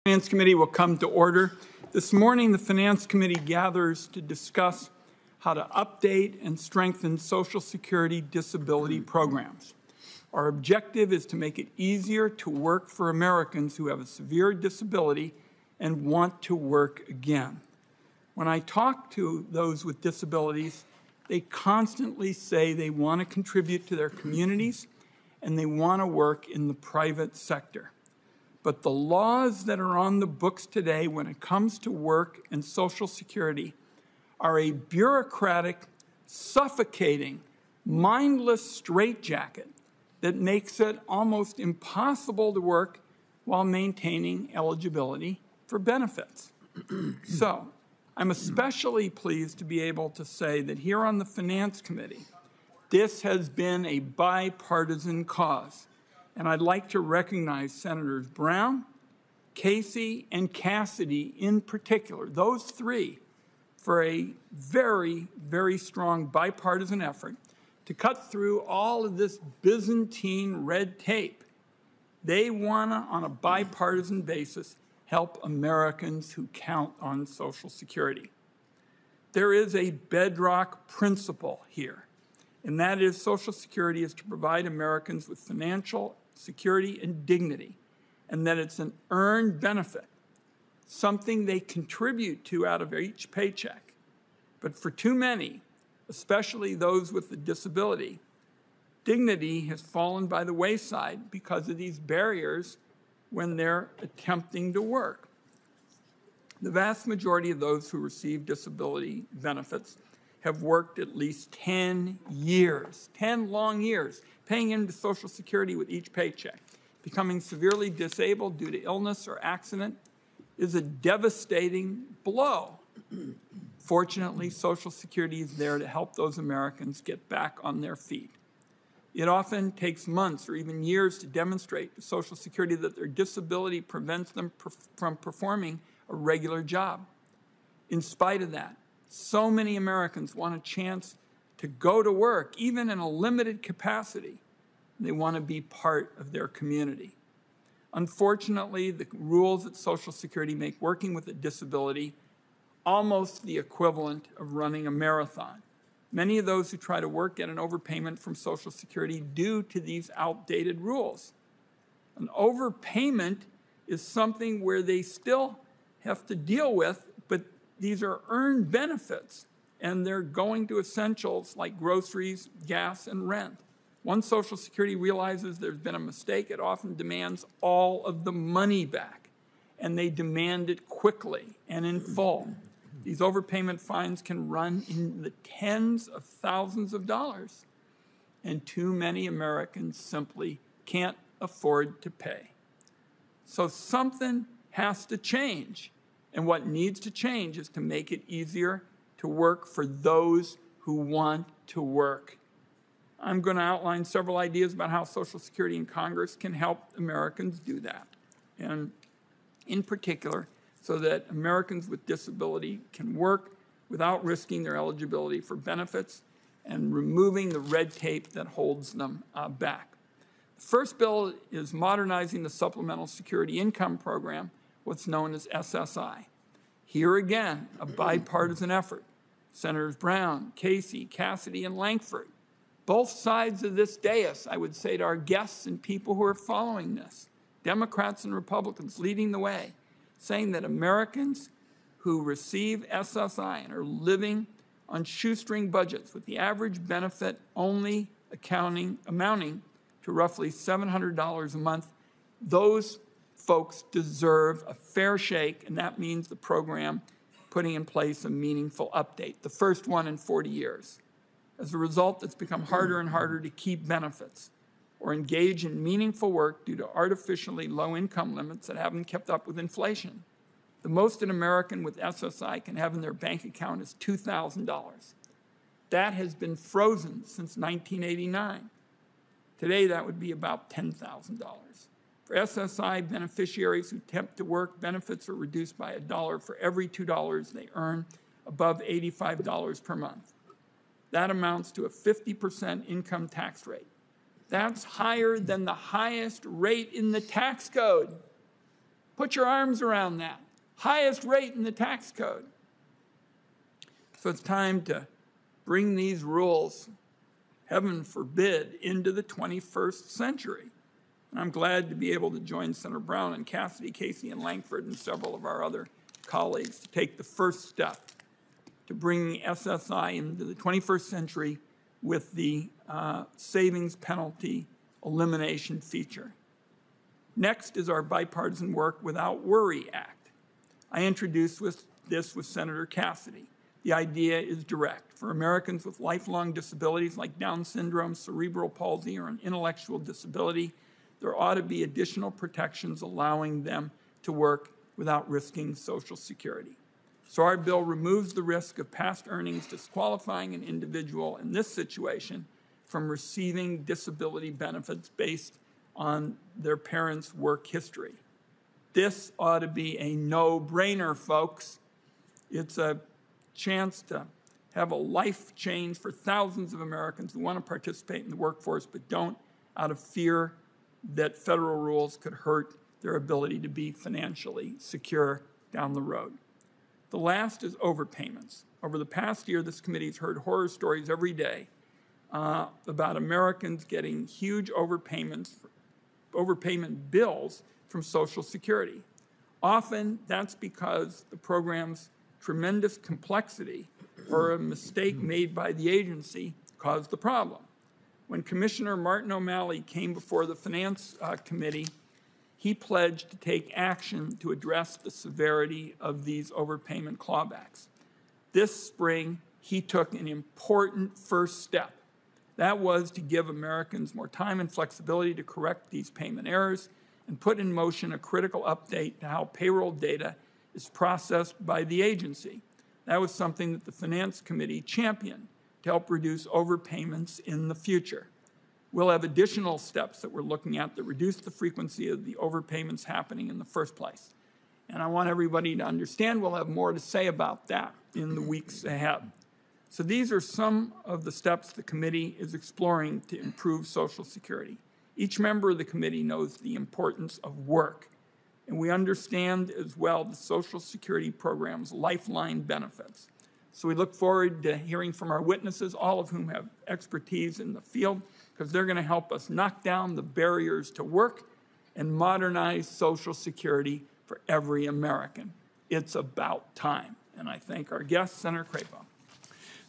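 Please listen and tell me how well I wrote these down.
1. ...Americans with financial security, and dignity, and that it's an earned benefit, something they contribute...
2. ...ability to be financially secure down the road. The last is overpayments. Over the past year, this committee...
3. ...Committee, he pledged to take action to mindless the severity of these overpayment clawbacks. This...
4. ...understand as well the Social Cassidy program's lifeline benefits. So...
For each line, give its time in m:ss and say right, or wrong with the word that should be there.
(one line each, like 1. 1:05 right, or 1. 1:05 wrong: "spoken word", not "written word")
1. 1:24 right
2. 6:13 right
3. 6:41 wrong: "address", not "mindless"
4. 7:28 wrong: "Security", not "Cassidy".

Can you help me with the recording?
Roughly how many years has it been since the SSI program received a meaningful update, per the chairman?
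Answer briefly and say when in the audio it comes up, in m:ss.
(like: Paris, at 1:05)
40, at 4:20.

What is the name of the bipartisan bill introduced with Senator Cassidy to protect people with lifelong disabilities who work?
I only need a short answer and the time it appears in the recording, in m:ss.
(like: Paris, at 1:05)
Work Without Worry Act, at 5:28.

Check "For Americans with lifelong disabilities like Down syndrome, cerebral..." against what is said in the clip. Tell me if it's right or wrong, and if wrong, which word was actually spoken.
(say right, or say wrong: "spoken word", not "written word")
right.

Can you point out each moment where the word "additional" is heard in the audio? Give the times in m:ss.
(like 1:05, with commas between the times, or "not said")
5:41, 7:09.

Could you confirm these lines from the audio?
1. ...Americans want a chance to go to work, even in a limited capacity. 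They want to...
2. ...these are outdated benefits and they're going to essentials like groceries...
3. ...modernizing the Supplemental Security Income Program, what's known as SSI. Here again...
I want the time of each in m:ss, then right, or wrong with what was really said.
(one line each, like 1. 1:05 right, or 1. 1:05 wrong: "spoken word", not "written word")
1. 2:19 right
2. 2:47 wrong: "earned", not "outdated"
3. 3:41 right.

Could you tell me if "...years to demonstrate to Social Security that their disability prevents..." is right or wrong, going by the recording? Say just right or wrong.
right.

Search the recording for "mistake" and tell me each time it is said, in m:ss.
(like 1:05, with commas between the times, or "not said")
2:55, 6:34.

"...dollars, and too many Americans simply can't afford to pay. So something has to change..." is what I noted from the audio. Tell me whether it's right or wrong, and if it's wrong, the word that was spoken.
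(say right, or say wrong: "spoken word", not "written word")
right.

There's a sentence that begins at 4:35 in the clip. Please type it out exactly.
That has been frozen since 1989.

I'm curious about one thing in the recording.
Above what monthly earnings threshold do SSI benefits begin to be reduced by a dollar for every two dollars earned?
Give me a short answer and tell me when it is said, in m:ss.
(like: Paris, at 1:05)
$85, at 4:48.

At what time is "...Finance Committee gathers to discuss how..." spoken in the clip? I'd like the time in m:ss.
0:02.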